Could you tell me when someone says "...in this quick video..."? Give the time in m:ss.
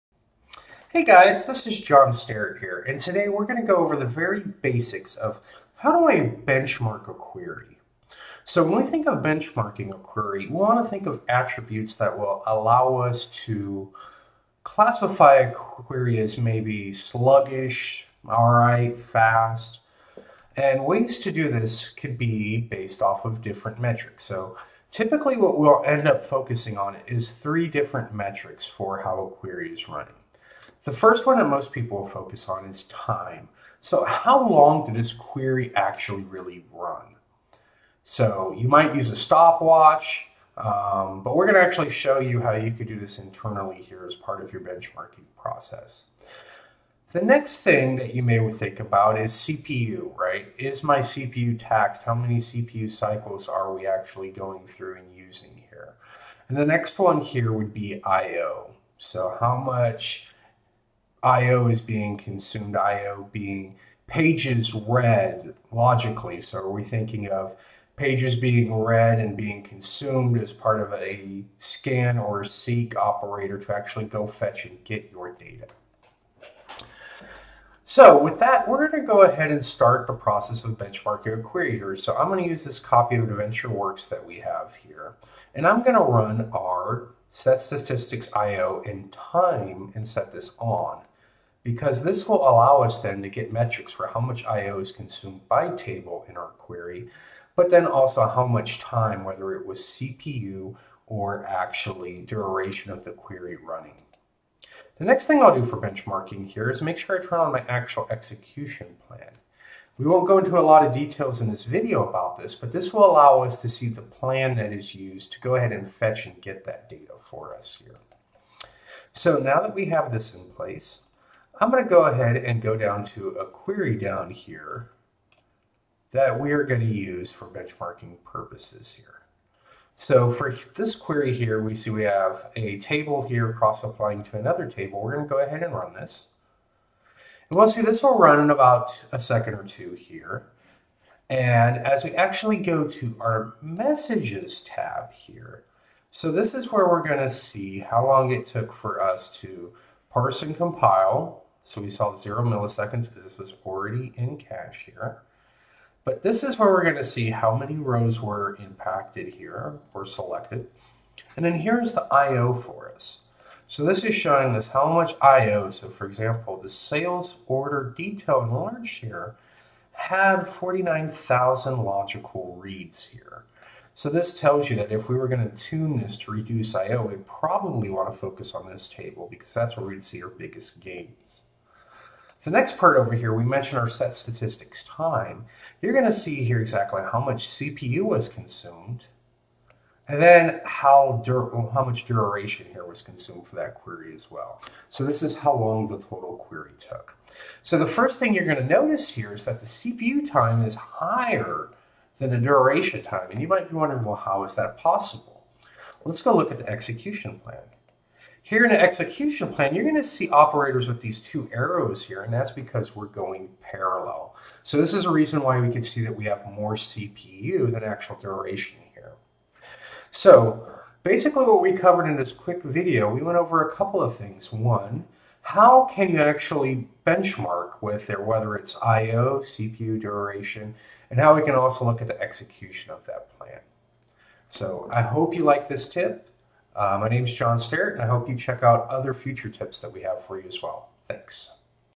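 3:42.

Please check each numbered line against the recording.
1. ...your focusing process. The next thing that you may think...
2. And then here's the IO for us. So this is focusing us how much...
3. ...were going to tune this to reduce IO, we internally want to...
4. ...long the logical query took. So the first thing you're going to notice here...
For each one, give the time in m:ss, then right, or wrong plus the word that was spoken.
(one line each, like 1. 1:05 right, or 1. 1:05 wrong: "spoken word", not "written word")
1. 0:44 wrong: "benchmarking", not "focusing"
2. 2:41 wrong: "showing", not "focusing"
3. 2:55 wrong: "probably", not "internally"
4. 3:15 wrong: "total", not "logical".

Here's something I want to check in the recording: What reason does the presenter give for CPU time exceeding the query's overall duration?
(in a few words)
going parallel.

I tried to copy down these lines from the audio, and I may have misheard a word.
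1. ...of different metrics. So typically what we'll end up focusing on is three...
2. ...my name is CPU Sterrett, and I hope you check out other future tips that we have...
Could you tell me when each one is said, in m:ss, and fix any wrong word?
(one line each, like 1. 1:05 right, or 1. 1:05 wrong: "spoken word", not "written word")
1. 0:23 right
2. 3:57 wrong: "John", not "CPU".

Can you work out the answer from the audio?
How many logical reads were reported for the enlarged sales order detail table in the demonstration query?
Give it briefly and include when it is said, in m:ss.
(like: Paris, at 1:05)
49,000, at 2:50.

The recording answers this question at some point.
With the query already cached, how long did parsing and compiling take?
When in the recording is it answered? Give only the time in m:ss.
2:32.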